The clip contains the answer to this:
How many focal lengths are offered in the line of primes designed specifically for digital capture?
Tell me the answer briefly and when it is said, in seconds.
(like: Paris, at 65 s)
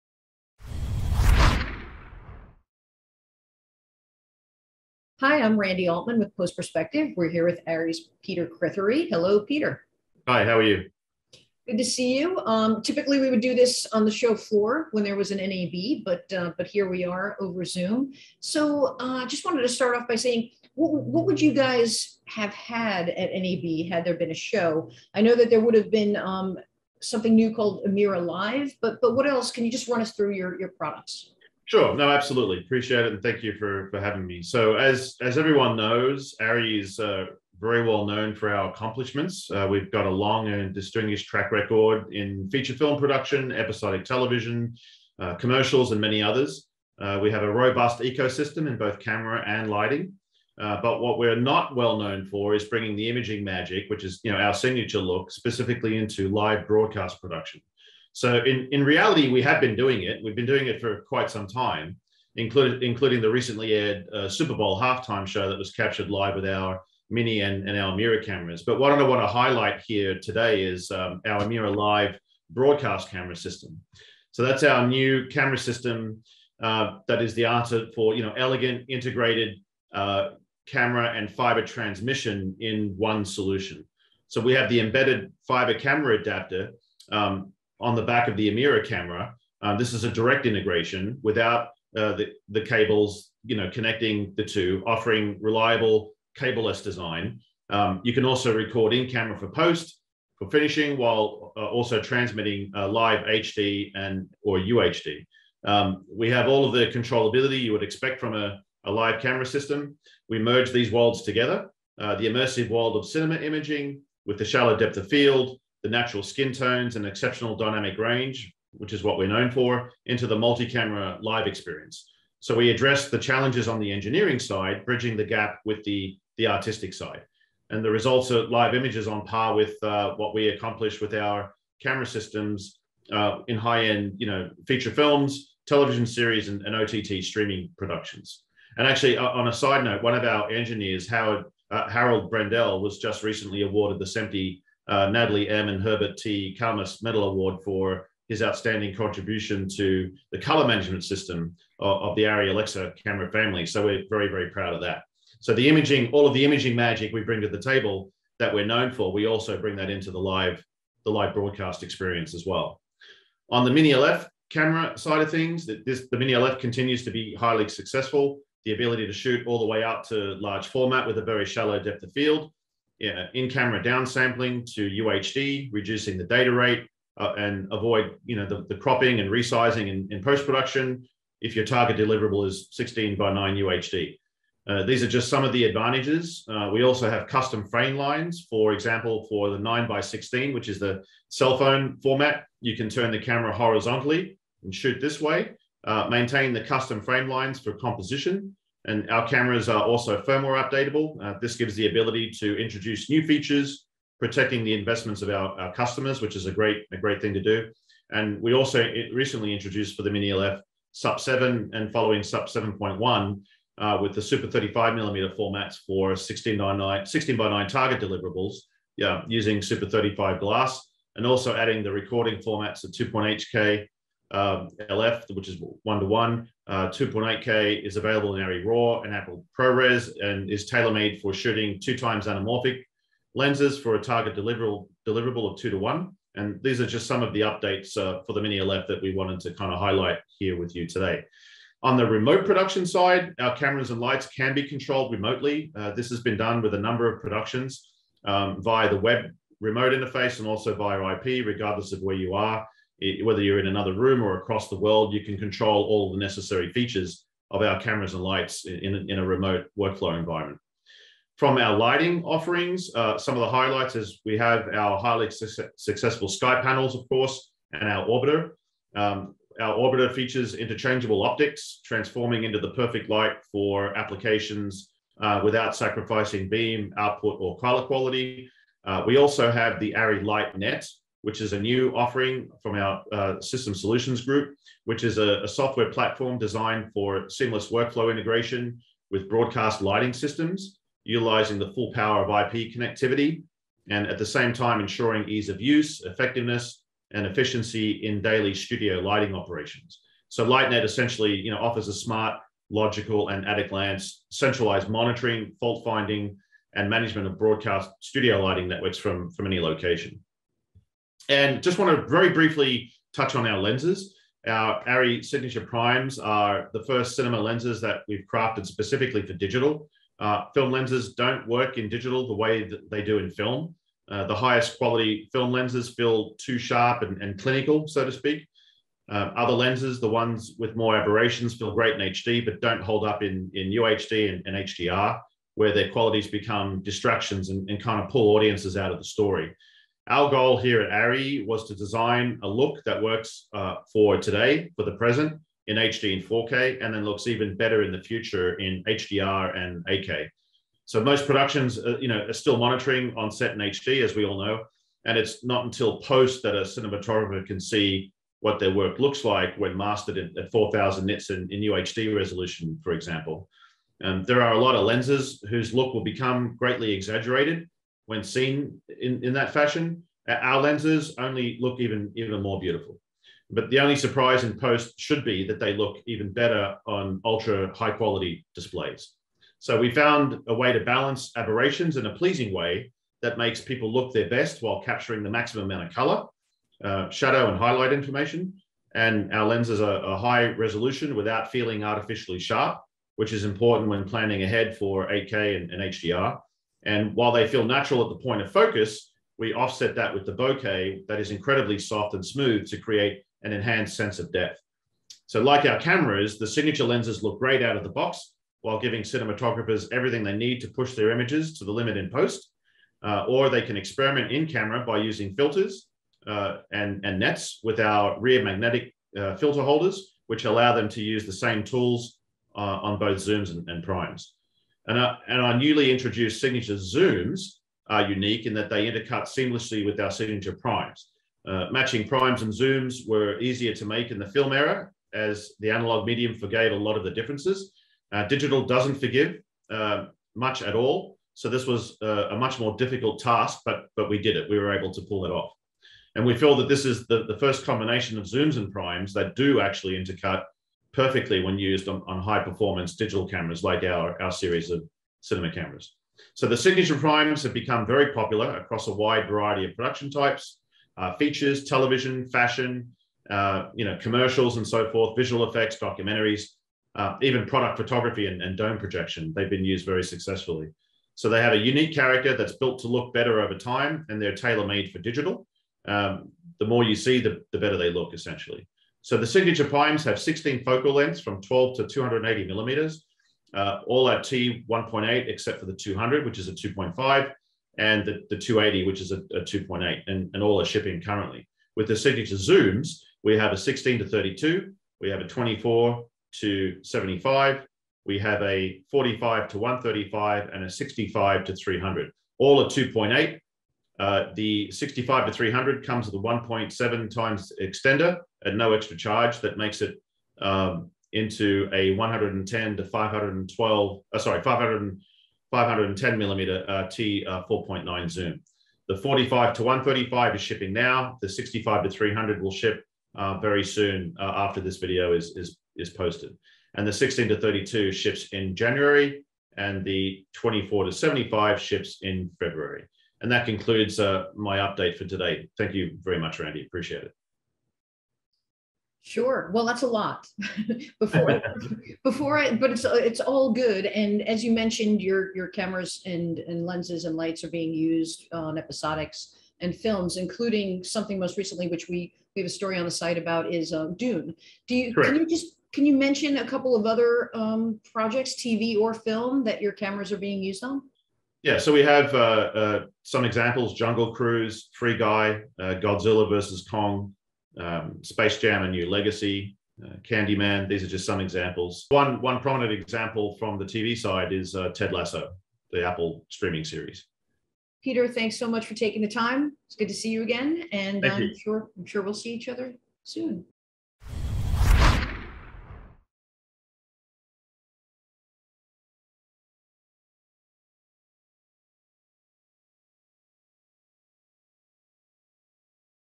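16, at 480 s.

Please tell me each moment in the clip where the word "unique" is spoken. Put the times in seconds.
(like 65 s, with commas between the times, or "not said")
428 s, 471 s.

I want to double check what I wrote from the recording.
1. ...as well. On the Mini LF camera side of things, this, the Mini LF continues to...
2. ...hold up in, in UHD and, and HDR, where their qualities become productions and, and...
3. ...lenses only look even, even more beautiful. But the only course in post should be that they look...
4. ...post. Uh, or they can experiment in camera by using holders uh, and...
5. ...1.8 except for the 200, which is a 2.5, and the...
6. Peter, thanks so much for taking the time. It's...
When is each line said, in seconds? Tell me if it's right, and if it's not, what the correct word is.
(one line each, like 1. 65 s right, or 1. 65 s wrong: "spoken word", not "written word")
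1. 162 s right
2. 332 s wrong: "distractions", not "productions"
3. 370 s wrong: "surprise", not "course"
4. 412 s wrong: "filters", not "holders"
5. 484 s right
6. 577 s right.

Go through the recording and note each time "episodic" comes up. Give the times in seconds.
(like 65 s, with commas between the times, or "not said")
43 s, 548 s.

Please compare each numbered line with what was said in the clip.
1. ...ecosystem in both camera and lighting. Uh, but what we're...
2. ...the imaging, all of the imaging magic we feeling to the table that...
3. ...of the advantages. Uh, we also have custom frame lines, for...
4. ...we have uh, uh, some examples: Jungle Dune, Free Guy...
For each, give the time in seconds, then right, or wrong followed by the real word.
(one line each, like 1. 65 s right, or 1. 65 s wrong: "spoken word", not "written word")
1. 47 s right
2. 155 s wrong: "bring", not "feeling"
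3. 185 s right
4. 561 s wrong: "Cruise", not "Dune".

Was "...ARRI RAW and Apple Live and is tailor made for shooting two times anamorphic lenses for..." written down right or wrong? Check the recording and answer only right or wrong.
wrong.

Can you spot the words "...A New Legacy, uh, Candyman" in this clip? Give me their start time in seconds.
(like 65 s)
568 s.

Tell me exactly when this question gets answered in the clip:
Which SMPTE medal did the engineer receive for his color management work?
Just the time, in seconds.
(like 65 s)
145 s.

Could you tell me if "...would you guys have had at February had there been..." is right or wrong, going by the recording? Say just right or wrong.
wrong.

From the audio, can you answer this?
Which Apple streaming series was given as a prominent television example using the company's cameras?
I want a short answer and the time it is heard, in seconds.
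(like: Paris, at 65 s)
Ted Lasso, at 574 s.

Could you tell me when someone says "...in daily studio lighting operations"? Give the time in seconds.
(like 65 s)
298 s.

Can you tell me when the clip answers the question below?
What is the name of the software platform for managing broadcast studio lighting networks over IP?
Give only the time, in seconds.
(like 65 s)
279 s.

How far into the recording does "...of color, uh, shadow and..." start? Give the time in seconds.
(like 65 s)
385 s.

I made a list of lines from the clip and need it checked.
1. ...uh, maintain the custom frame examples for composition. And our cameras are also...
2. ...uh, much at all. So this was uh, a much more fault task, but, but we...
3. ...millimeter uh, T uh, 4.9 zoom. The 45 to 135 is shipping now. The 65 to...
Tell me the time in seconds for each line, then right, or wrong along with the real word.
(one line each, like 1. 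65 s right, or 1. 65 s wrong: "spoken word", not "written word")
1. 195 s wrong: "lines", not "examples"
2. 439 s wrong: "difficult", not "fault"
3. 516 s right.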